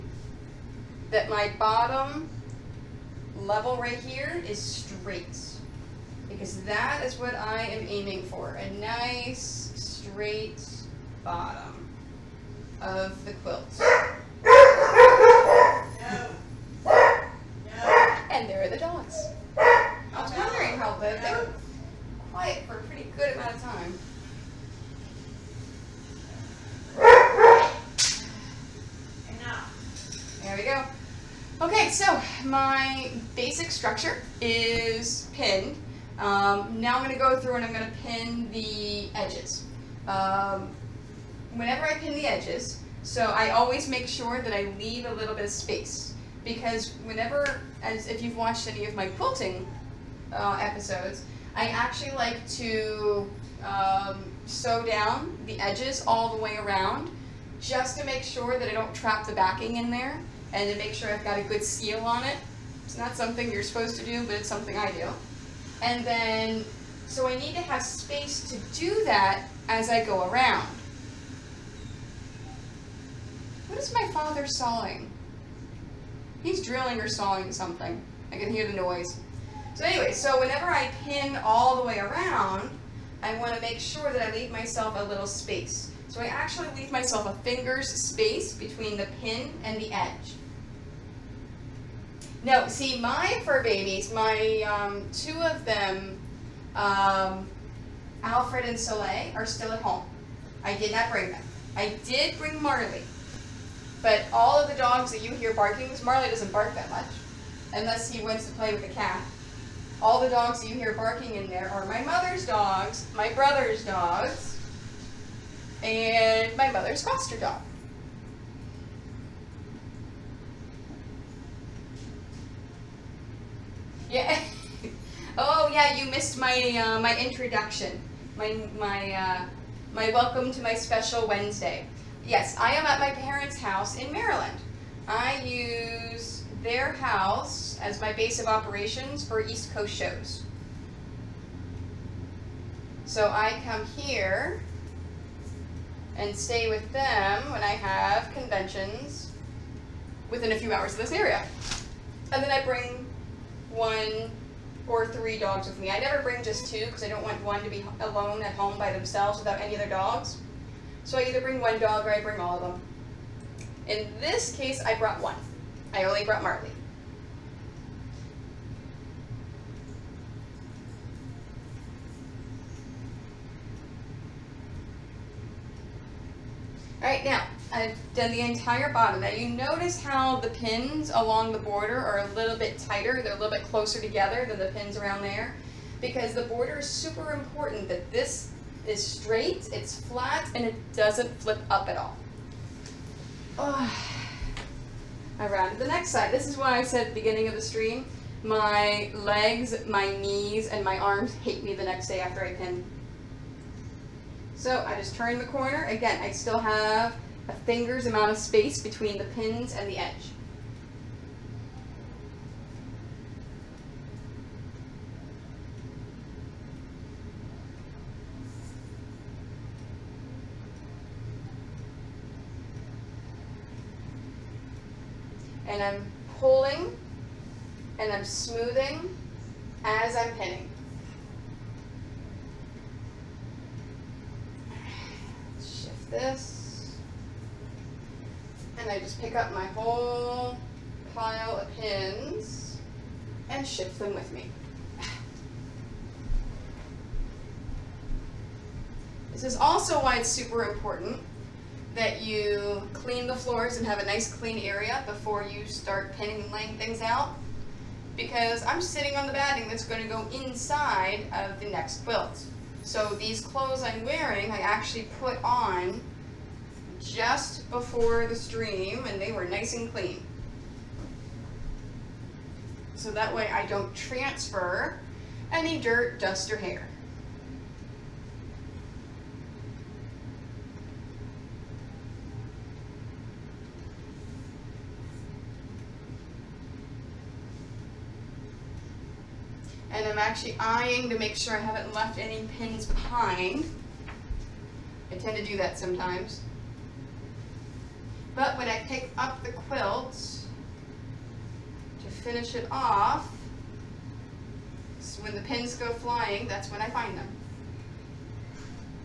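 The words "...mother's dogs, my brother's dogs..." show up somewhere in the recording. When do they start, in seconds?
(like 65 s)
112 s.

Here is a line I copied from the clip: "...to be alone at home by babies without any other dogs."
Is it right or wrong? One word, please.
wrong.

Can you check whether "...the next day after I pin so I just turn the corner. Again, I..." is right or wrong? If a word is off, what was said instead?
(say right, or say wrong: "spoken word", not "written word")
right.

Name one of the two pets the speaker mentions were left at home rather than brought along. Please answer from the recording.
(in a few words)
Alfred.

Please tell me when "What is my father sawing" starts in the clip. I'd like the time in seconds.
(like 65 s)
73 s.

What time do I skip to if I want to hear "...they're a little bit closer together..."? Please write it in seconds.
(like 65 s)
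183 s.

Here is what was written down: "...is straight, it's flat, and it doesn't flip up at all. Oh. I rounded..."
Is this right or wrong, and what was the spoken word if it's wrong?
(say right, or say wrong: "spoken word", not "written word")
right.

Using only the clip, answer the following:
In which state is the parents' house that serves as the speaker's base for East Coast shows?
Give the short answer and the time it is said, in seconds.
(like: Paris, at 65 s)
Maryland, at 134 s.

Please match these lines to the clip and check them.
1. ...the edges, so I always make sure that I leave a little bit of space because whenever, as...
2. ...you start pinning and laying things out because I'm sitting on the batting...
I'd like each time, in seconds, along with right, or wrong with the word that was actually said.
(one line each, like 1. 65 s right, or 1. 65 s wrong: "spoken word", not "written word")
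1. 42 s right
2. 255 s right.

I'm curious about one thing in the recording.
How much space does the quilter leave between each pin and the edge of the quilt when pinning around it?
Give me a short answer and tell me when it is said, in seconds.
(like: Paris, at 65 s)
A finger's space, at 87 s.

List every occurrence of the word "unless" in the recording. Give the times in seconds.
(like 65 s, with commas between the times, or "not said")
107 s.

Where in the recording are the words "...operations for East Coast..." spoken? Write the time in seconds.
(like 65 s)
138 s.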